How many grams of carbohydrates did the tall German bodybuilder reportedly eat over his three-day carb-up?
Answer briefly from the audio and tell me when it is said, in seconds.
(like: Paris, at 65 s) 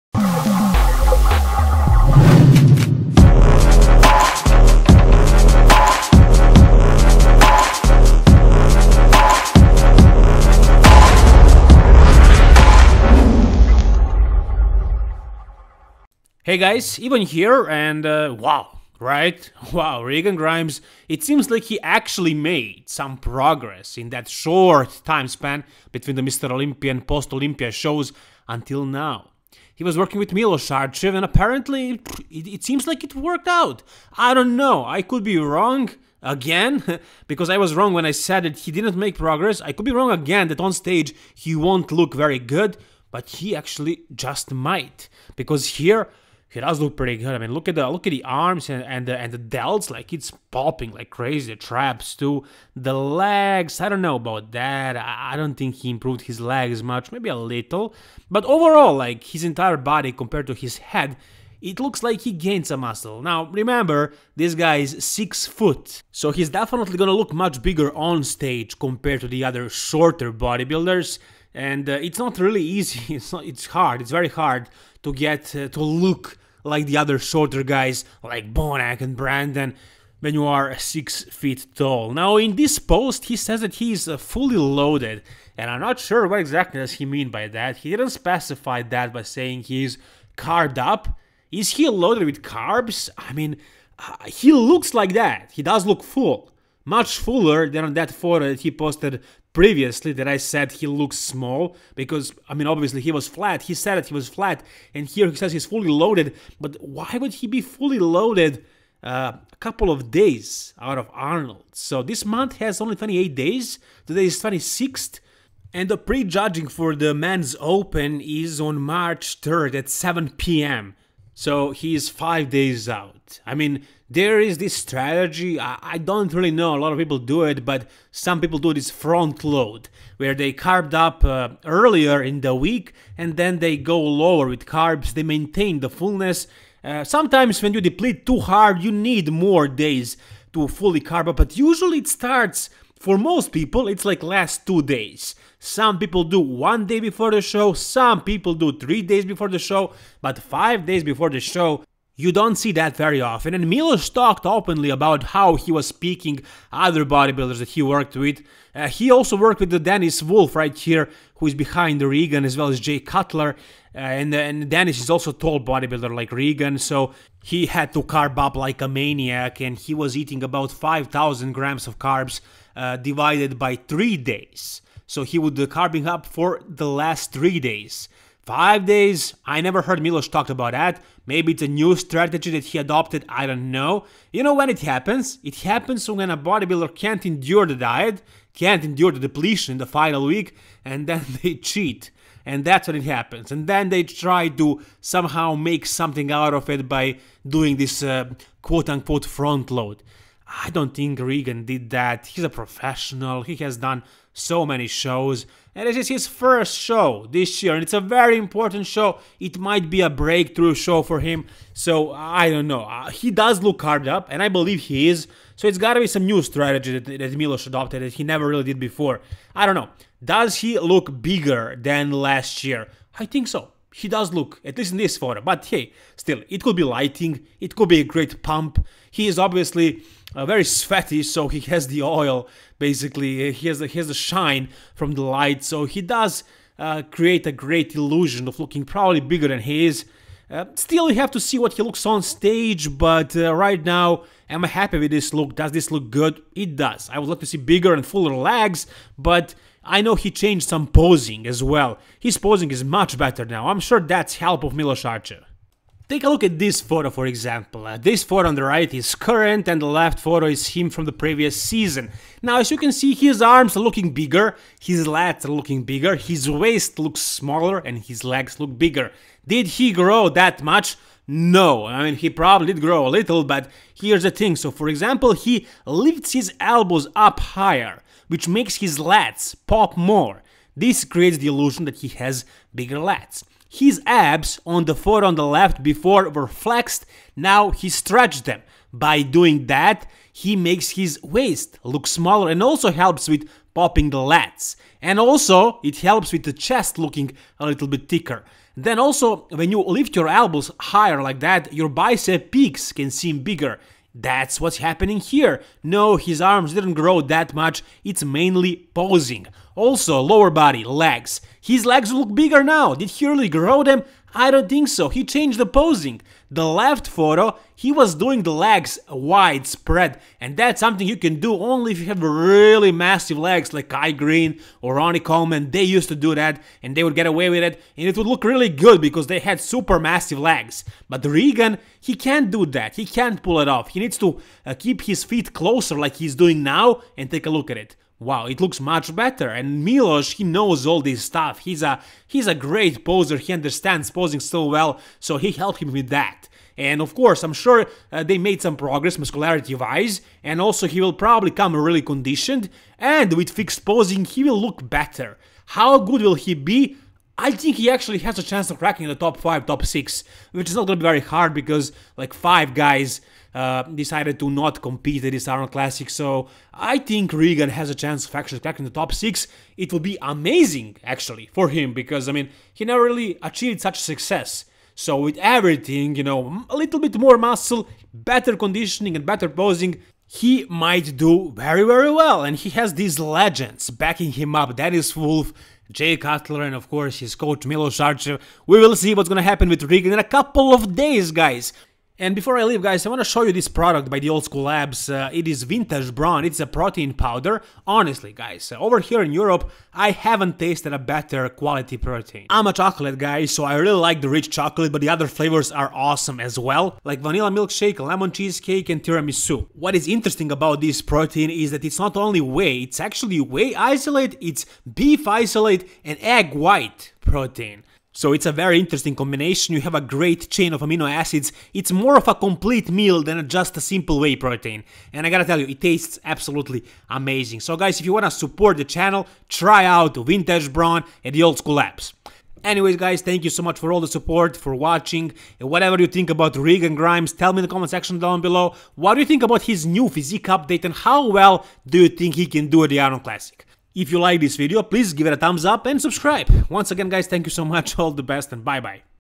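5,000 grams, at 170 s.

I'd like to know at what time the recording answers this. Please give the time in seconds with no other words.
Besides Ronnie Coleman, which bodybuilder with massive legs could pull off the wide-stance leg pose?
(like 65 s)
323 s.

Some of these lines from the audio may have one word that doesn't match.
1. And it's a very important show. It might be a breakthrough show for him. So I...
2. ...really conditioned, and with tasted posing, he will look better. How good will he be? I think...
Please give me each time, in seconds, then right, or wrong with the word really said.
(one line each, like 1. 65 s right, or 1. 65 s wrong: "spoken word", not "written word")
1. 207 s right
2. 351 s wrong: "fixed", not "tasted".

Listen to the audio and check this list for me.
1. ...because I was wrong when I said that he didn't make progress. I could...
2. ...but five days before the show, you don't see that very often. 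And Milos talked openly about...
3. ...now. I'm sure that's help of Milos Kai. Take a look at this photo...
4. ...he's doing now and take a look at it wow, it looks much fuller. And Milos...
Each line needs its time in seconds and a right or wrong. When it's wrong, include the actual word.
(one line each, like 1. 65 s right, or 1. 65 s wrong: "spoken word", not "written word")
1. 37 s right
2. 150 s right
3. 253 s wrong: "Sarcev", not "Kai"
4. 336 s wrong: "better", not "fuller".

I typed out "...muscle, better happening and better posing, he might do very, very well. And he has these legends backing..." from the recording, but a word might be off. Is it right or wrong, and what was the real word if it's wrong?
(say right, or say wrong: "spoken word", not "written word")
wrong: "conditioning", not "happening".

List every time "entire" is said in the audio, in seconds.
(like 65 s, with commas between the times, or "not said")
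59 s.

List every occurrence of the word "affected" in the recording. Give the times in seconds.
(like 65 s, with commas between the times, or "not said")
not said.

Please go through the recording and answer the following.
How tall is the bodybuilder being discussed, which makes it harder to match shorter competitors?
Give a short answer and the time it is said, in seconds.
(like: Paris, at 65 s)
6 foot, at 65 s.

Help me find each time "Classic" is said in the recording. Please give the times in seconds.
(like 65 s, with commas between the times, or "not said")
365 s, 443 s.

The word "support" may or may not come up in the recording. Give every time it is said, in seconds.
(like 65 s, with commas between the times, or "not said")
428 s, 434 s.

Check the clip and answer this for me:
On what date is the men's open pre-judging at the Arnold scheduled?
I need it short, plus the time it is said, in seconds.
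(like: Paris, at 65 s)
March 3rd, at 118 s.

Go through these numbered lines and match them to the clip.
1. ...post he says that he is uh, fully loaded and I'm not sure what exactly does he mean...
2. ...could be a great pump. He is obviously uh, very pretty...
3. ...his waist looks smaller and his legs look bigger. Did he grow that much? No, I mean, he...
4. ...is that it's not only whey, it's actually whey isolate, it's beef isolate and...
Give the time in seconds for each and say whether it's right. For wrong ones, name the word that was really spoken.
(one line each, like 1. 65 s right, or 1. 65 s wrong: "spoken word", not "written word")
1. 82 s right
2. 227 s wrong: "sweaty", not "pretty"
3. 266 s right
4. 411 s right.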